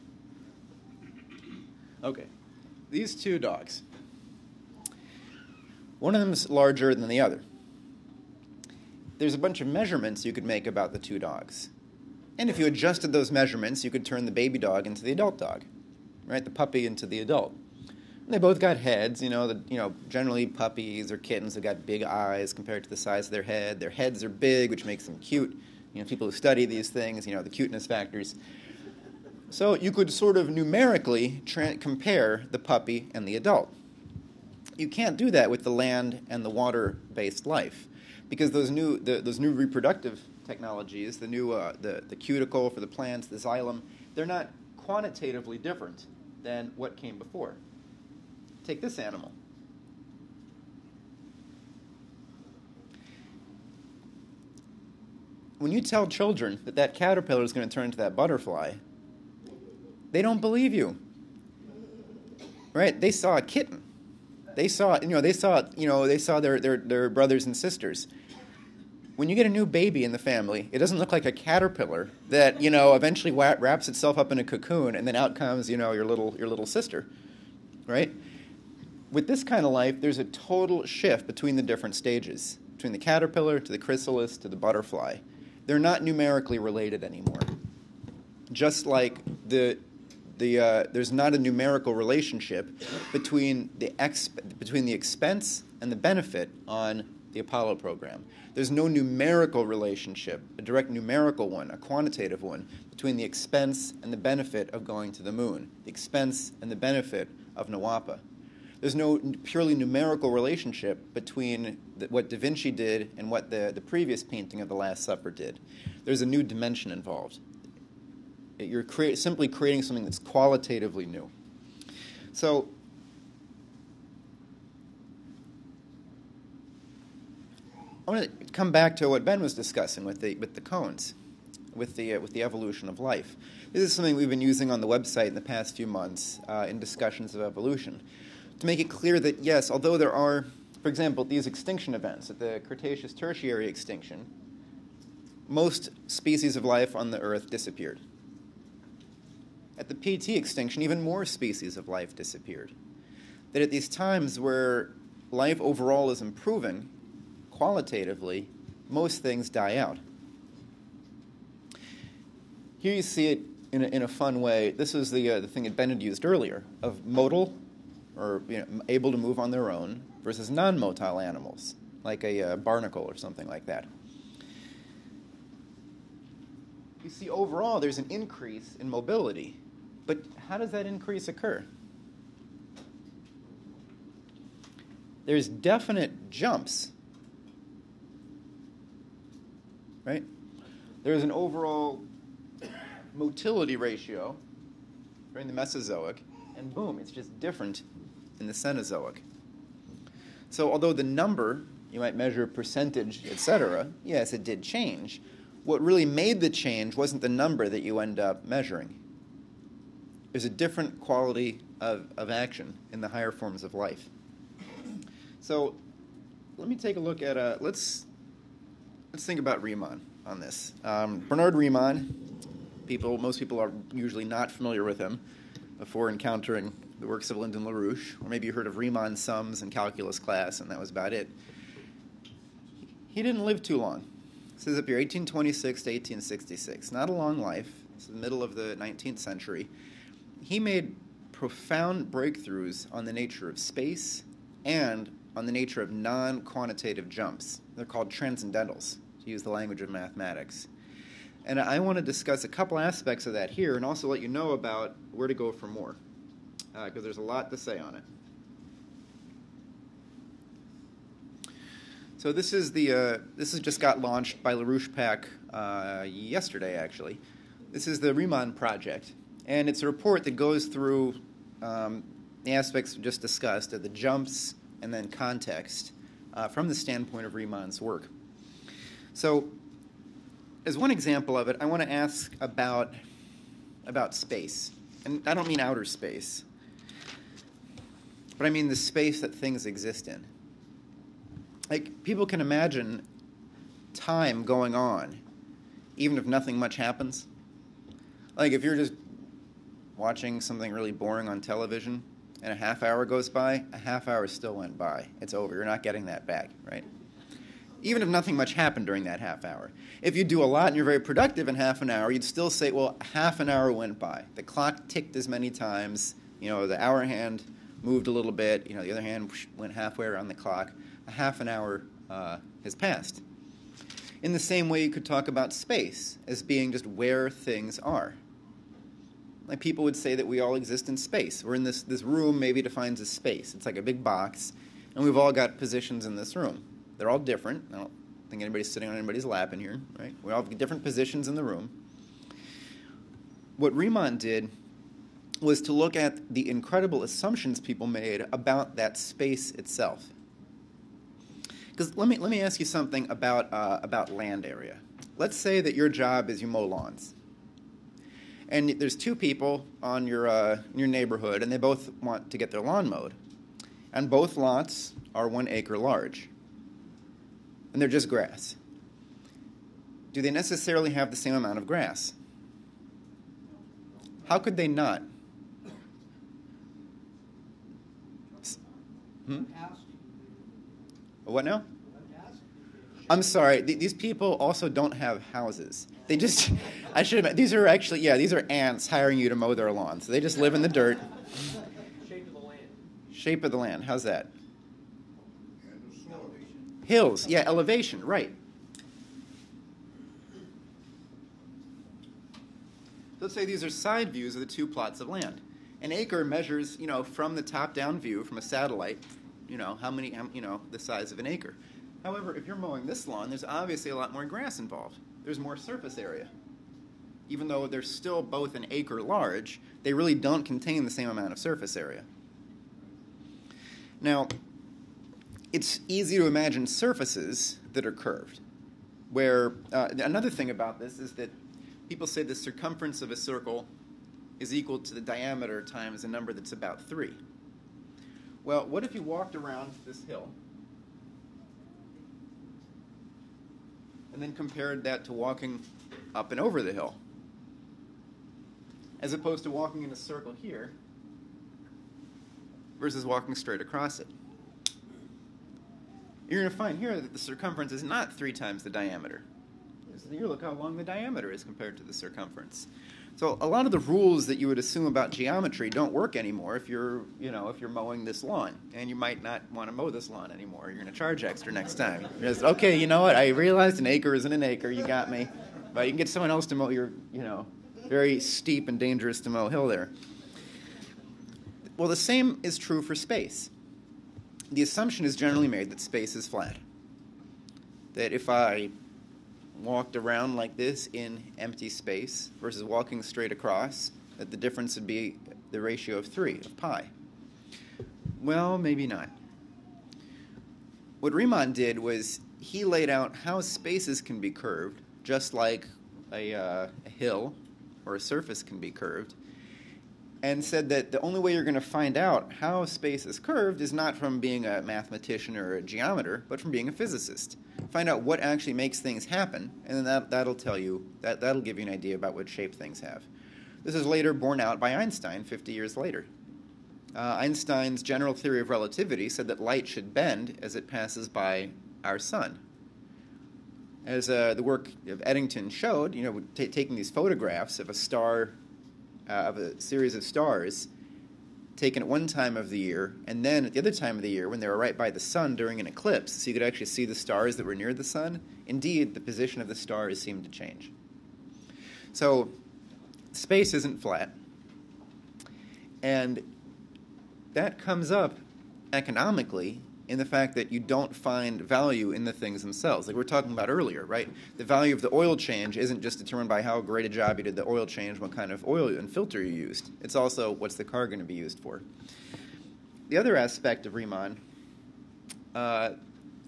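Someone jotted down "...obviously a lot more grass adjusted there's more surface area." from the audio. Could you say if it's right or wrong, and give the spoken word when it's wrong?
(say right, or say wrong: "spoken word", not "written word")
wrong: "involved", not "adjusted".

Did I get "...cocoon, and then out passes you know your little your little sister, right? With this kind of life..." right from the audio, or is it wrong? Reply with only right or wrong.
wrong.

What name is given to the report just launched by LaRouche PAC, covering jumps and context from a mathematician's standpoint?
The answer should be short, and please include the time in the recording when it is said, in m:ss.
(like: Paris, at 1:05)
The Riemann project, at 4:28.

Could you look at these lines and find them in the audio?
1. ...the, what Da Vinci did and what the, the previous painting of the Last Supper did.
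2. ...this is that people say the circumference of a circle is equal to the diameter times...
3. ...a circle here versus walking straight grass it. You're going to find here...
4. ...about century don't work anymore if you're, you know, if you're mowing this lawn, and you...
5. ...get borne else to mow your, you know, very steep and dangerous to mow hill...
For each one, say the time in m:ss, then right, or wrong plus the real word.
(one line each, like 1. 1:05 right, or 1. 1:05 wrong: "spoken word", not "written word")
1. 1:51 right
2. 7:10 right
3. 7:29 wrong: "across", not "grass"
4. 7:44 wrong: "geometry", not "century"
5. 7:55 wrong: "someone", not "borne".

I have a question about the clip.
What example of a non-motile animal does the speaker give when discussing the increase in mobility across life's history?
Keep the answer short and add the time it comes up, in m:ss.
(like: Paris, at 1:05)
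barnacle, at 2:52.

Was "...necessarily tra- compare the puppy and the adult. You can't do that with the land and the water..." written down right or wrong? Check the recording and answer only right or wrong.
wrong.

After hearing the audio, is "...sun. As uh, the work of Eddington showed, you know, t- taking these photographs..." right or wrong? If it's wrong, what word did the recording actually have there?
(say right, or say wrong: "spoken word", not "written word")
right.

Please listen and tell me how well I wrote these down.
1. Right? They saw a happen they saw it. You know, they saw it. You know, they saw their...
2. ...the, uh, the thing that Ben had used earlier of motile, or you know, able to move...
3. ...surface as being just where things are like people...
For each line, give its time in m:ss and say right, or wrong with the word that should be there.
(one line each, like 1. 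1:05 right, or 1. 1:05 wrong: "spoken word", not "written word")
1. 1:02 wrong: "kitten", not "happen"
2. 2:45 right
3. 5:25 wrong: "space", not "surface".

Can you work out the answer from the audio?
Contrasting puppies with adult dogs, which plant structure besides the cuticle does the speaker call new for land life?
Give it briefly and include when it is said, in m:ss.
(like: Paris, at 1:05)
xylem, at 0:43.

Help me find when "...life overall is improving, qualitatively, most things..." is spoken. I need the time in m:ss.
2:35.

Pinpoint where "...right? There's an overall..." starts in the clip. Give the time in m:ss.
3:10.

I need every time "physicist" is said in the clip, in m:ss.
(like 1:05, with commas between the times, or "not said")
8:36.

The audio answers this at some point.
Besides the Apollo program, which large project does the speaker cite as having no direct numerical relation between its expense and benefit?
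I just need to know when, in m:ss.
1:47.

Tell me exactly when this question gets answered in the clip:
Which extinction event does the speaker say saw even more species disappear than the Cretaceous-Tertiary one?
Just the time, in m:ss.
2:29.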